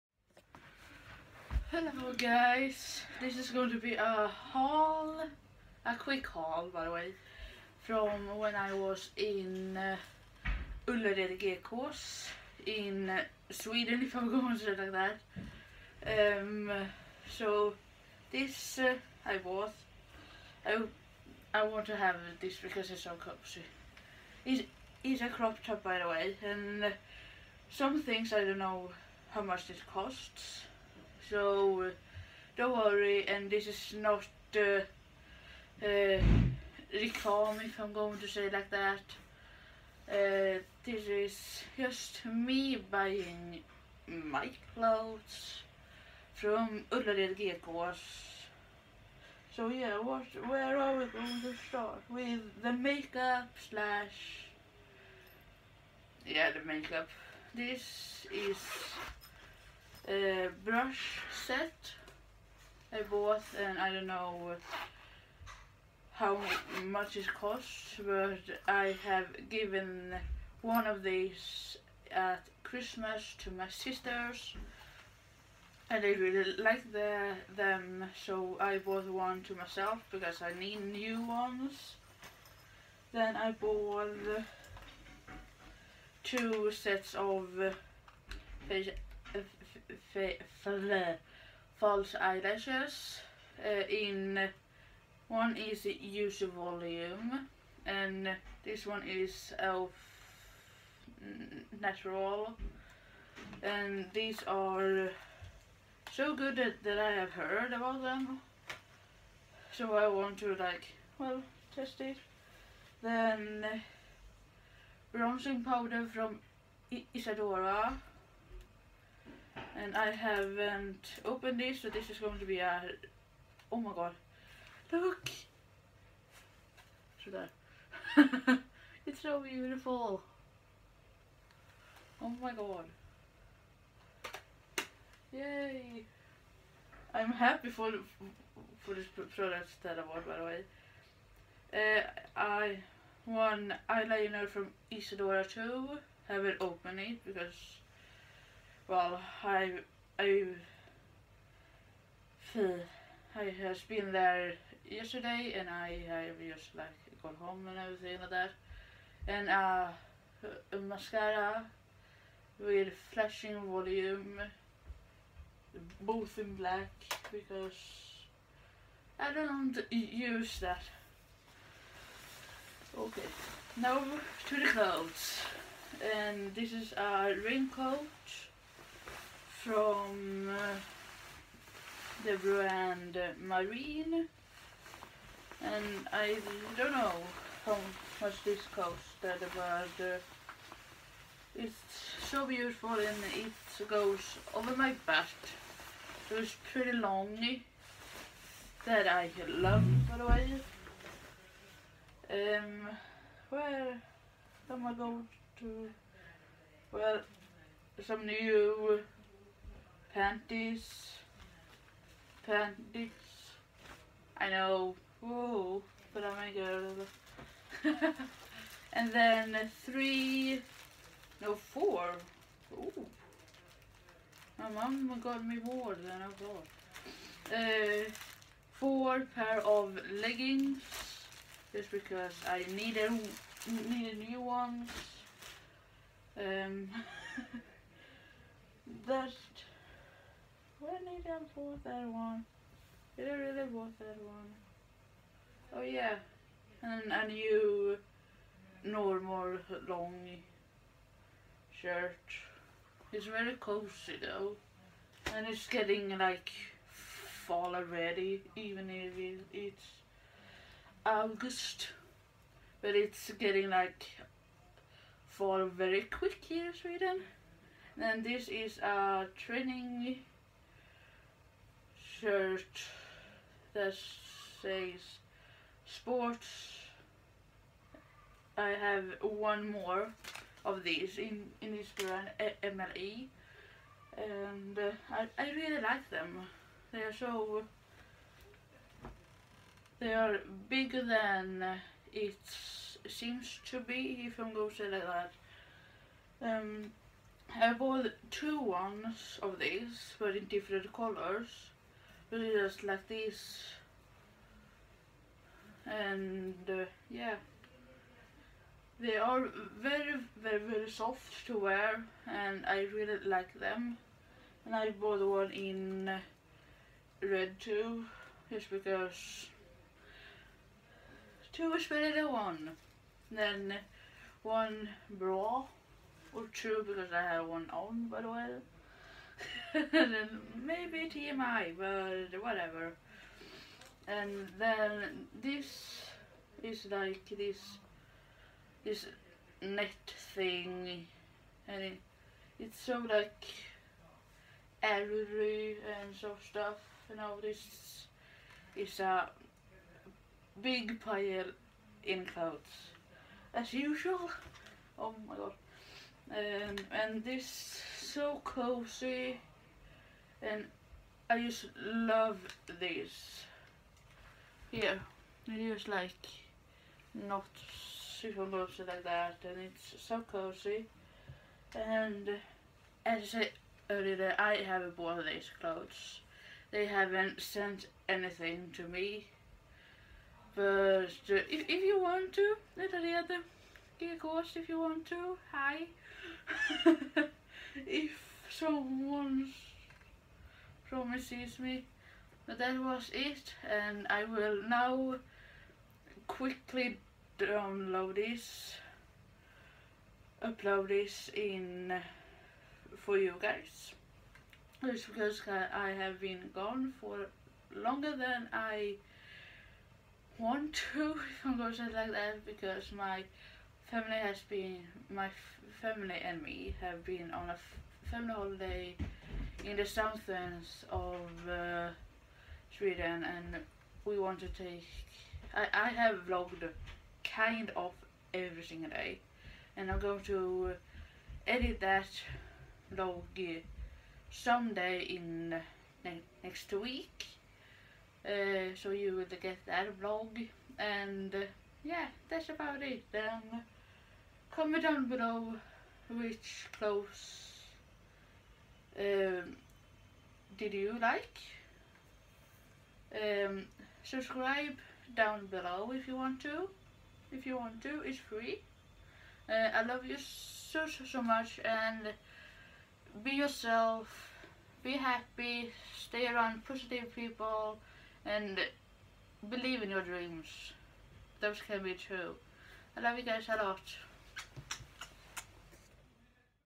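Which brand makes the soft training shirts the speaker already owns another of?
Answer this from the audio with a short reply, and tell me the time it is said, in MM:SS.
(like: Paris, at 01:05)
MLE, at 04:42.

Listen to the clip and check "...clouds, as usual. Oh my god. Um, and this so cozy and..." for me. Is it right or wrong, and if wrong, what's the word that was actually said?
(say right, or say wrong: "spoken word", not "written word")
right.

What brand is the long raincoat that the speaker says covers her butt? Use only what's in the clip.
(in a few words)
Marine.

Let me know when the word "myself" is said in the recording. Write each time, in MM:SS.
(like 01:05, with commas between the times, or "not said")
01:19.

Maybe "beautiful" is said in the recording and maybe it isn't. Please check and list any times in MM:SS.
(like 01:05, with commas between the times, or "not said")
02:09, 03:12.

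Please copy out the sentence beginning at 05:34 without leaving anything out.
And then this is like this this net thing, and it, it's so like airy and so stuff.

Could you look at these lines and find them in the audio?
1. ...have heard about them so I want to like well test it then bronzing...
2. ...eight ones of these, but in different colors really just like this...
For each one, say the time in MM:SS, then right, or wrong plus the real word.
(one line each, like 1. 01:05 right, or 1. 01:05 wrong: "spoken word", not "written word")
1. 01:47 right
2. 04:58 wrong: "two", not "eight".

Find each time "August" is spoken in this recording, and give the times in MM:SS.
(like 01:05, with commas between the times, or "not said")
04:21.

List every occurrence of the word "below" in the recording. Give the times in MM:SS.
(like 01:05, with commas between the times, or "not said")
07:25, 07:35.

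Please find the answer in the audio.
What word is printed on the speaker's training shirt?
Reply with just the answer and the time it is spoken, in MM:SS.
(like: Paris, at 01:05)
Sports, at 04:35.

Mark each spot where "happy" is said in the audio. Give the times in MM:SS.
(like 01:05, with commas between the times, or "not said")
02:17, 07:44.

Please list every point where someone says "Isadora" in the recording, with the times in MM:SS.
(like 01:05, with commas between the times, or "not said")
01:57, 02:24.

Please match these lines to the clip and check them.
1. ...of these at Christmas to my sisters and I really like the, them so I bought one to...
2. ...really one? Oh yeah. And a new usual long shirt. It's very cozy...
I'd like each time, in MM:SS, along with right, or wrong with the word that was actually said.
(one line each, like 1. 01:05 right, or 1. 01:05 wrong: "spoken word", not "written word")
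1. 01:10 right
2. 04:03 wrong: "normal", not "usual".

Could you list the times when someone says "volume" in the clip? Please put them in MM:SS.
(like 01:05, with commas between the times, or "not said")
01:36, 02:43.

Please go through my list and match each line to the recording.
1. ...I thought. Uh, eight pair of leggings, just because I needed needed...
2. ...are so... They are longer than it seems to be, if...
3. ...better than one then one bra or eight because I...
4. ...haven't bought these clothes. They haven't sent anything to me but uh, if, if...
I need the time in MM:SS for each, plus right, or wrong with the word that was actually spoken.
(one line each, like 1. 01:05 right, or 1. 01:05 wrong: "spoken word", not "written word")
1. 03:46 wrong: "four", not "eight"
2. 04:46 wrong: "bigger", not "longer"
3. 05:21 wrong: "two", not "eight"
4. 06:14 right.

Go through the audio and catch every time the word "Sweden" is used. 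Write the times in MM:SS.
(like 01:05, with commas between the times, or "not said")
00:13, 04:26, 07:02.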